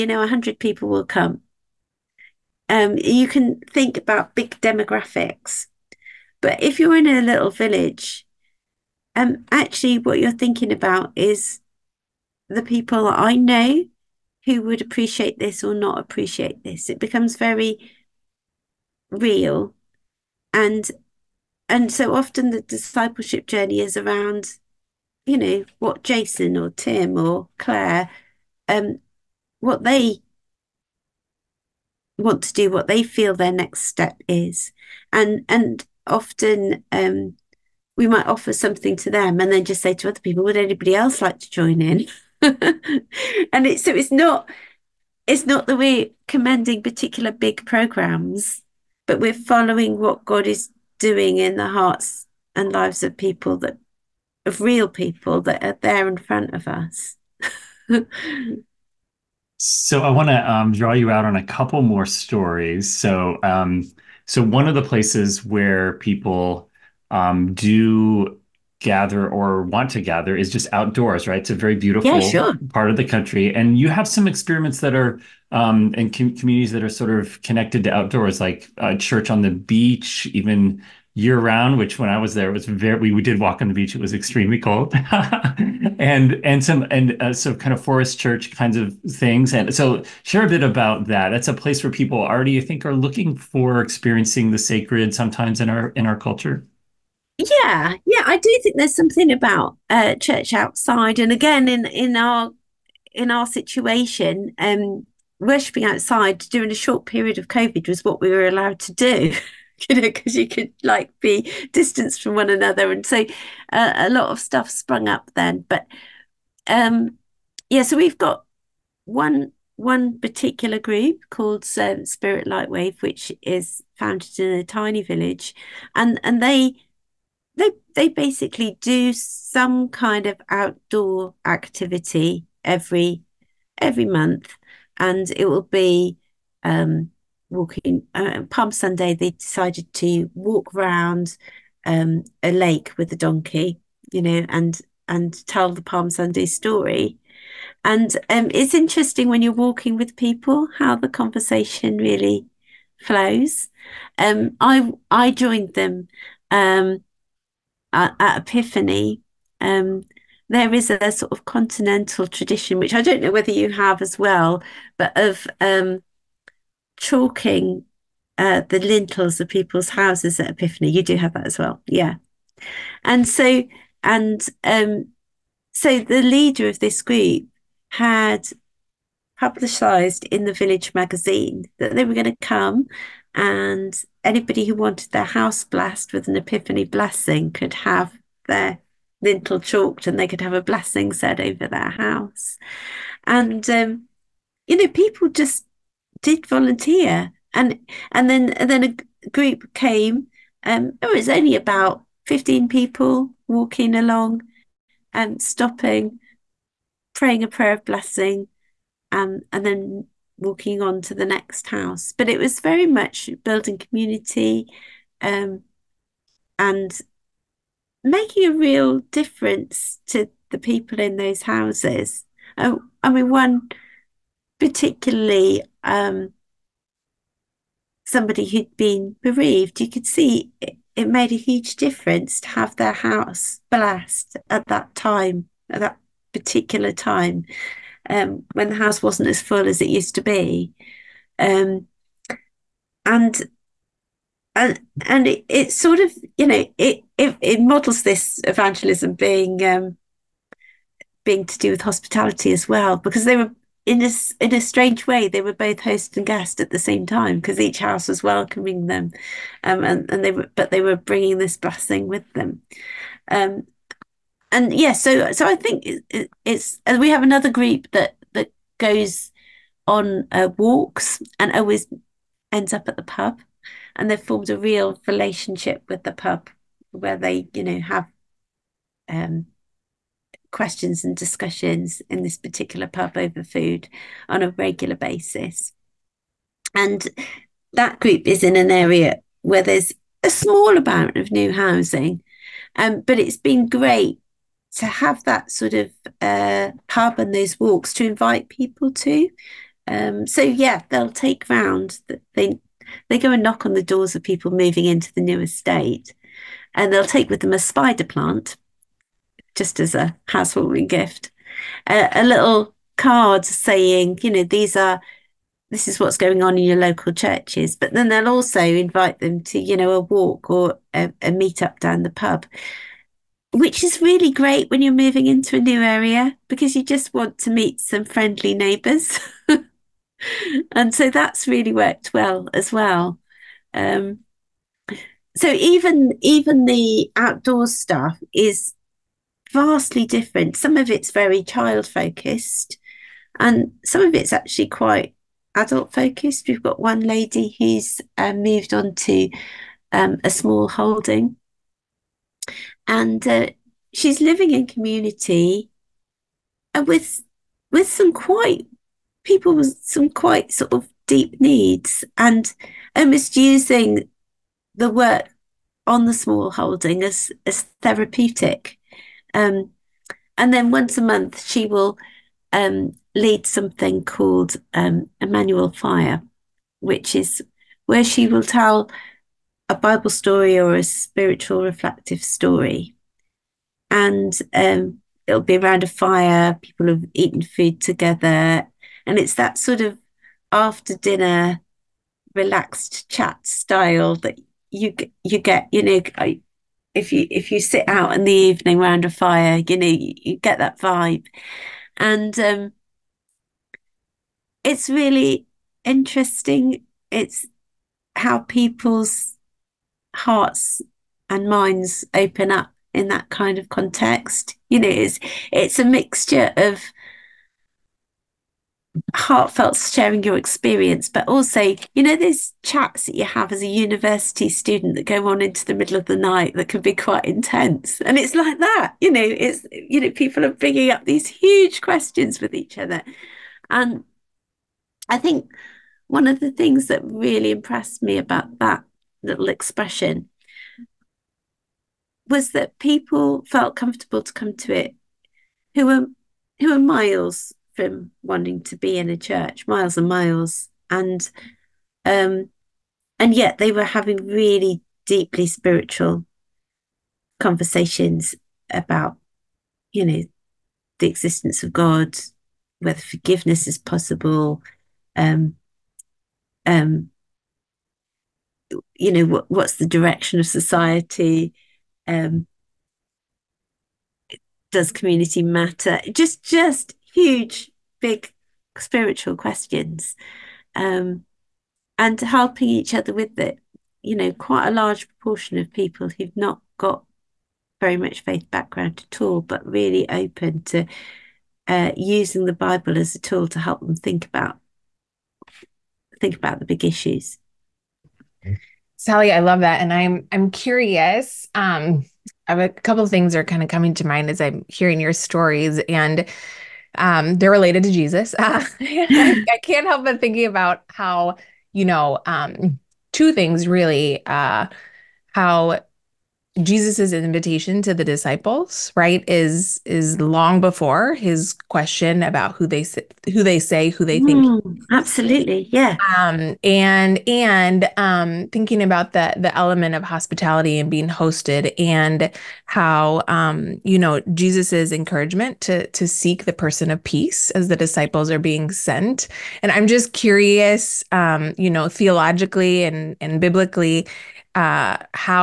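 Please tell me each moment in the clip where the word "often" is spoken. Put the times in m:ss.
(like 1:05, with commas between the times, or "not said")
0:22, 0:36.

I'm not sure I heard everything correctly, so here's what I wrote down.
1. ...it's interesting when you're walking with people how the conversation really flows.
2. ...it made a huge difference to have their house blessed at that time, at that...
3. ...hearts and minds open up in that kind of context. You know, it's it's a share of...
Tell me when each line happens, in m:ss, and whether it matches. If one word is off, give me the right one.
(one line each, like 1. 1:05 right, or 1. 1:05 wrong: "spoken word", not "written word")
1. 2:28 right
2. 3:50 right
3. 6:50 wrong: "mixture", not "share".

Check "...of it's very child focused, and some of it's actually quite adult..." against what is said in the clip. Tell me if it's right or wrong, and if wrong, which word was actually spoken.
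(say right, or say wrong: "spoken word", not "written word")
right.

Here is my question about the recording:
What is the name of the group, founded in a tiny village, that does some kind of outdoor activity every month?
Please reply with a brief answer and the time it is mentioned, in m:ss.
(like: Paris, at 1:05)
Spirit Lightwave, at 2:02.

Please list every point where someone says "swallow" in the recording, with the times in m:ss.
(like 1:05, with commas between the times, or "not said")
not said.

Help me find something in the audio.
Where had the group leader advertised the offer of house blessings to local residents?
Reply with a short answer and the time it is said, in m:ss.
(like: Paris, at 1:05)
Village magazine, at 3:00.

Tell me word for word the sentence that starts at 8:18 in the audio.
Sally, I love that, and I'm I'm curious.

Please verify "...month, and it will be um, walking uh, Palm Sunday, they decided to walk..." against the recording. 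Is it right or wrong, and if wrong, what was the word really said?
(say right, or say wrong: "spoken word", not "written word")
right.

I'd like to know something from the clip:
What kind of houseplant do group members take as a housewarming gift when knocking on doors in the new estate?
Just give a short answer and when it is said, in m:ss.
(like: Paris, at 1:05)
Spider plant, at 5:07.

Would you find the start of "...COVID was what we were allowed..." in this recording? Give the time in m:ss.
1:47.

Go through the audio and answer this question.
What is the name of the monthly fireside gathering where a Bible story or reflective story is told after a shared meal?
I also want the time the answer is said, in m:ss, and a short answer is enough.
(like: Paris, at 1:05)
Emmanuel Fire, at 6:15.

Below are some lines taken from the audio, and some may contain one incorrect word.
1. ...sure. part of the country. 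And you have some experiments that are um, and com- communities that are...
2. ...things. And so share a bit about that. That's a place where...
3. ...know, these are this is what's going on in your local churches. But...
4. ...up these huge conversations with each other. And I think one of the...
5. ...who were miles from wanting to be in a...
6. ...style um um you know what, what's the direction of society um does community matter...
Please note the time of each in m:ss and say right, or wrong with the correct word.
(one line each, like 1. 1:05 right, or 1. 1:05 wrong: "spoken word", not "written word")
1. 1:12 right
2. 1:29 right
3. 5:14 right
4. 7:10 wrong: "questions", not "conversations"
5. 7:26 right
6. 7:43 wrong: "possible", not "style".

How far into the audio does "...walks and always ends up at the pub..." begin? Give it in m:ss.
4:30.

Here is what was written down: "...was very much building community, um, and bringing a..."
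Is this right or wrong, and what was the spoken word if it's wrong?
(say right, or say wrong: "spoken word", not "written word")
wrong: "making", not "bringing".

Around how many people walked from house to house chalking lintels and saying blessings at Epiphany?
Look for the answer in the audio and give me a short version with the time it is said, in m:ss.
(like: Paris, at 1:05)
15, at 3:22.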